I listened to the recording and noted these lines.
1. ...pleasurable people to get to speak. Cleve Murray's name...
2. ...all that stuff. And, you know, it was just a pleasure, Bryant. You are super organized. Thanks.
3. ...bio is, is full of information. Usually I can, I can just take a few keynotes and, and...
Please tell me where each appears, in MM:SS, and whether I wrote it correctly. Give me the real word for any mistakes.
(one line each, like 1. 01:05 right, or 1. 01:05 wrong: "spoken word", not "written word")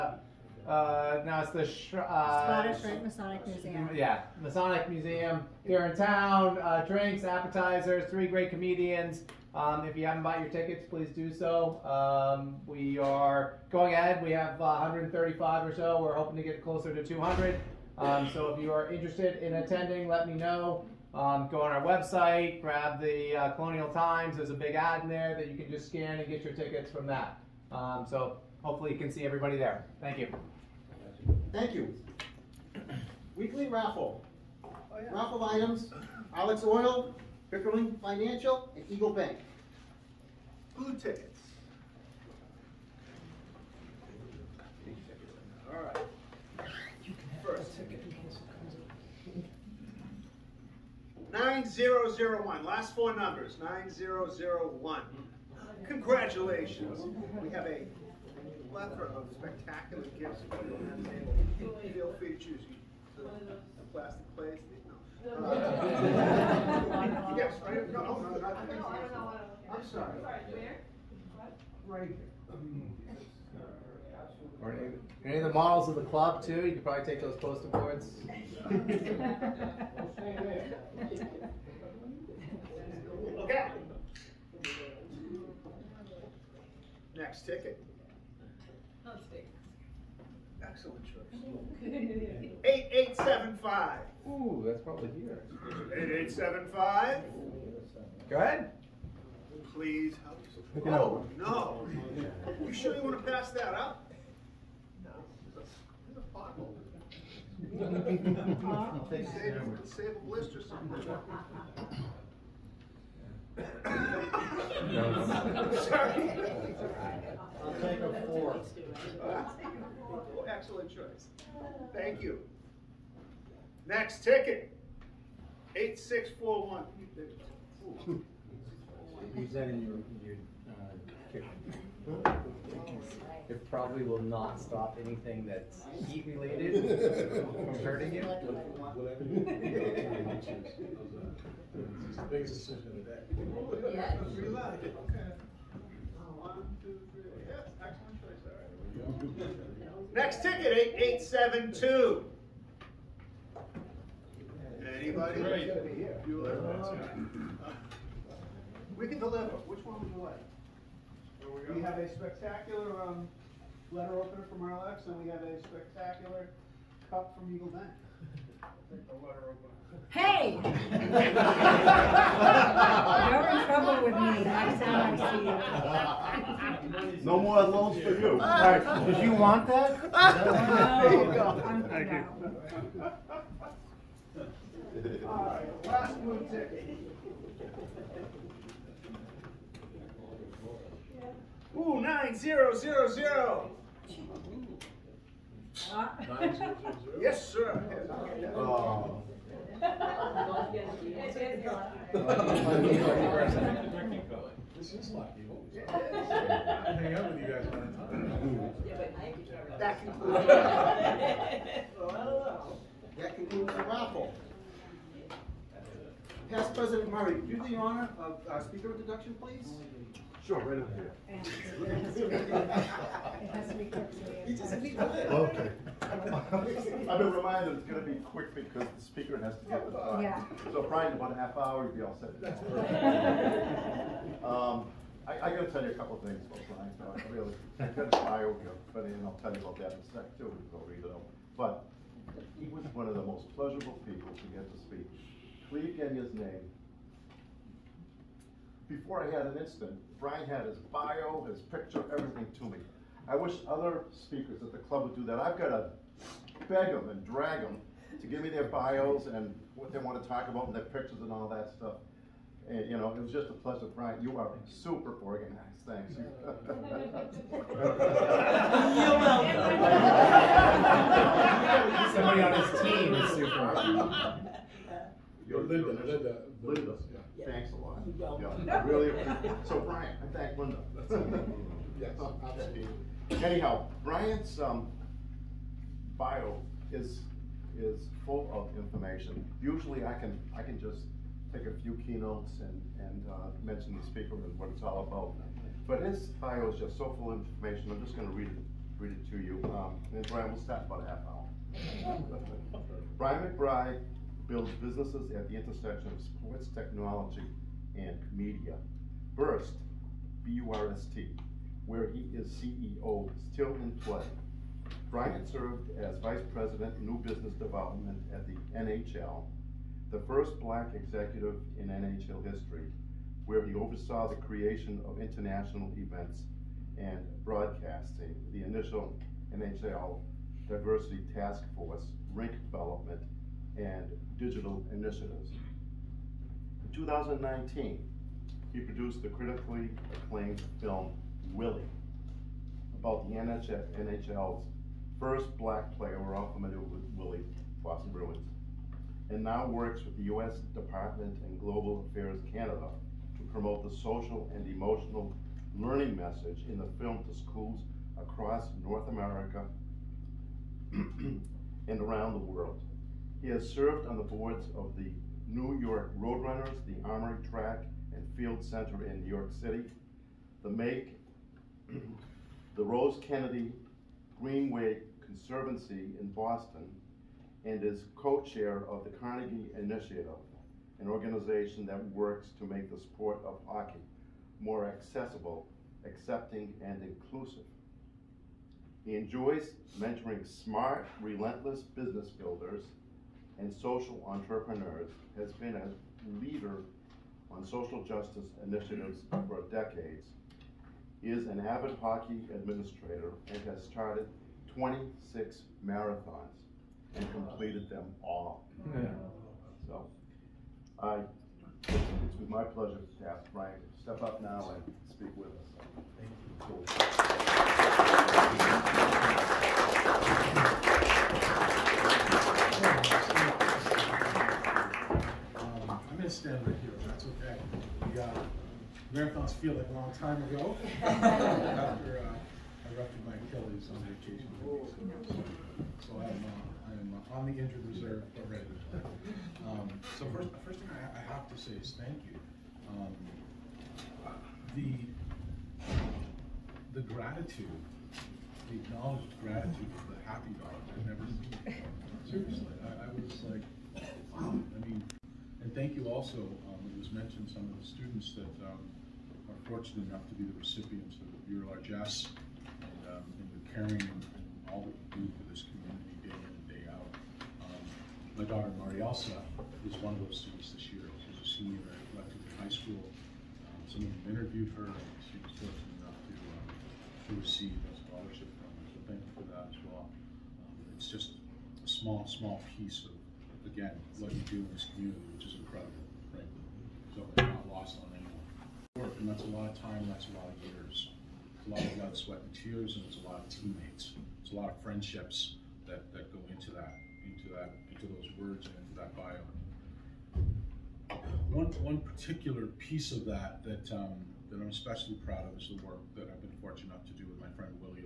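1. 04:03 wrong: "Genya", not "Murray"
2. 04:21 right
3. 04:46 right.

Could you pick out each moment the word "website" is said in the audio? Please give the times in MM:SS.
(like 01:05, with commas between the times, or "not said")
00:21.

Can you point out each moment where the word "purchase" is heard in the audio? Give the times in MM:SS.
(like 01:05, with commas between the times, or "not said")
not said.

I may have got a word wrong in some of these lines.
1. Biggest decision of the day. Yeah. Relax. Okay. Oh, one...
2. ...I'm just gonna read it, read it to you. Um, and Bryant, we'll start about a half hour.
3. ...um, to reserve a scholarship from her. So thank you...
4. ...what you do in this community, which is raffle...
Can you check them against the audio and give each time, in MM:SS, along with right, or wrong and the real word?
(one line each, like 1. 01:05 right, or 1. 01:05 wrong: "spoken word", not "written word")
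1. 02:22 right
2. 04:57 right
3. 07:56 wrong: "receive", not "reserve"
4. 08:04 wrong: "incredible", not "raffle".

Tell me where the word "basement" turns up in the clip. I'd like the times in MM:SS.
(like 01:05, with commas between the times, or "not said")
not said.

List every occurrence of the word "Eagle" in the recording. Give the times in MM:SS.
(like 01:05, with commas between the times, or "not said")
00:38, 02:47.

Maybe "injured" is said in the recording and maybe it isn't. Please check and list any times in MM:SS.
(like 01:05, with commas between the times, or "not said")
07:17.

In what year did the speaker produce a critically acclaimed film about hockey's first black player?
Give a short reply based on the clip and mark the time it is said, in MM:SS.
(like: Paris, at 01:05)
2019, at 05:36.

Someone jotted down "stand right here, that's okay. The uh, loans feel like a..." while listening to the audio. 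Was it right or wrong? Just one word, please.
wrong.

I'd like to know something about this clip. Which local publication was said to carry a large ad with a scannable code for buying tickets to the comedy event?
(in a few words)
Colonial Times.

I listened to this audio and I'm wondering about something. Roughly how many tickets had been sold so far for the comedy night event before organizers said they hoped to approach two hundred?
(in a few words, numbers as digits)
135.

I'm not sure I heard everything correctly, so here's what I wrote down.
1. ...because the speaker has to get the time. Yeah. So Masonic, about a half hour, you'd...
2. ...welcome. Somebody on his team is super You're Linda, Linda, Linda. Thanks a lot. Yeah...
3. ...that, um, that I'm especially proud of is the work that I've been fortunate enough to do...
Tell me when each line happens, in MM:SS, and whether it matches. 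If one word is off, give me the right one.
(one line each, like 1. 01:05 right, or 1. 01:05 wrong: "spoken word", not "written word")
1. 03:48 wrong: "Bryant", not "Masonic"
2. 04:29 right
3. 08:23 right.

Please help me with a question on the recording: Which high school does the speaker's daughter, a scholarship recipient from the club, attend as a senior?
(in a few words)
Lexington High School.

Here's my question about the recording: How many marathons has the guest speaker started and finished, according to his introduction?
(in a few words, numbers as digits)
26.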